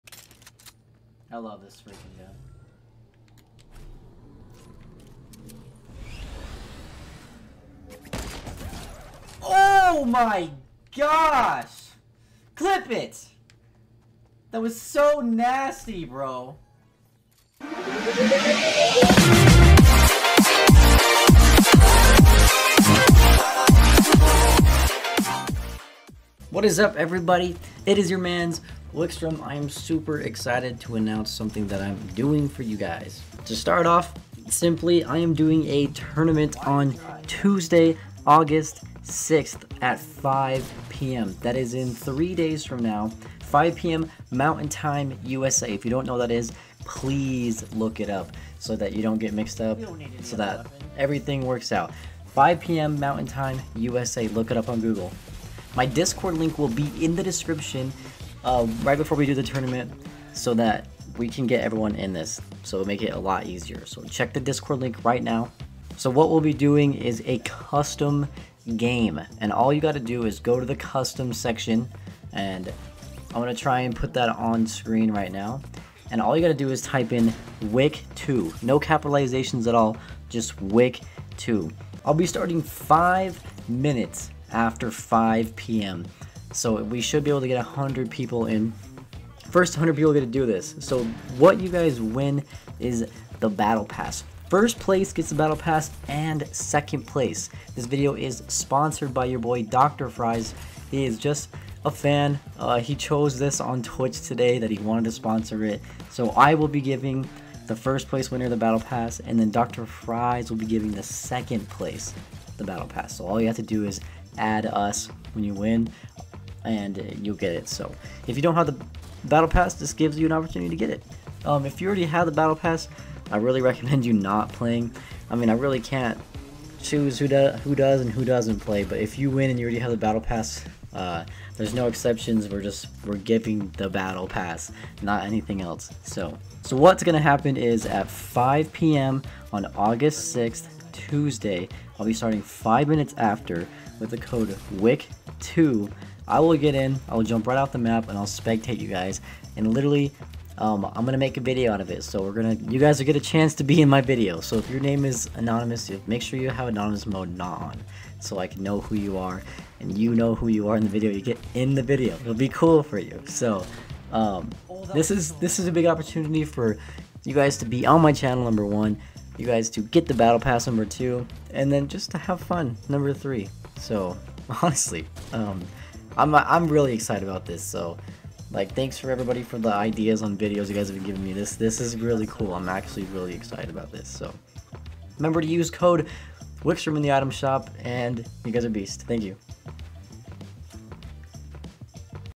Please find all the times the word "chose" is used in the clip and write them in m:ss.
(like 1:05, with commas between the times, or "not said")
1:42.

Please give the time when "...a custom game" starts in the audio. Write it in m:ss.
1:07.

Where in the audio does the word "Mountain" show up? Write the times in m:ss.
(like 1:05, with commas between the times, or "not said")
0:44, 0:52.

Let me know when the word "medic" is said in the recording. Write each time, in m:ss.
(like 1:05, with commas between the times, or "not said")
not said.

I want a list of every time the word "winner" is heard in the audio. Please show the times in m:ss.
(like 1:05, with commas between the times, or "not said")
1:48.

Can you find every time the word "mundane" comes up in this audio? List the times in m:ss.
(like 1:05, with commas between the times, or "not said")
not said.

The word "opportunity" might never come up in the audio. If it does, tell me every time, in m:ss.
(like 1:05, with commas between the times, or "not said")
2:00, 2:45.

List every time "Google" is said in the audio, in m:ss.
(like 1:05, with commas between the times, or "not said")
0:54.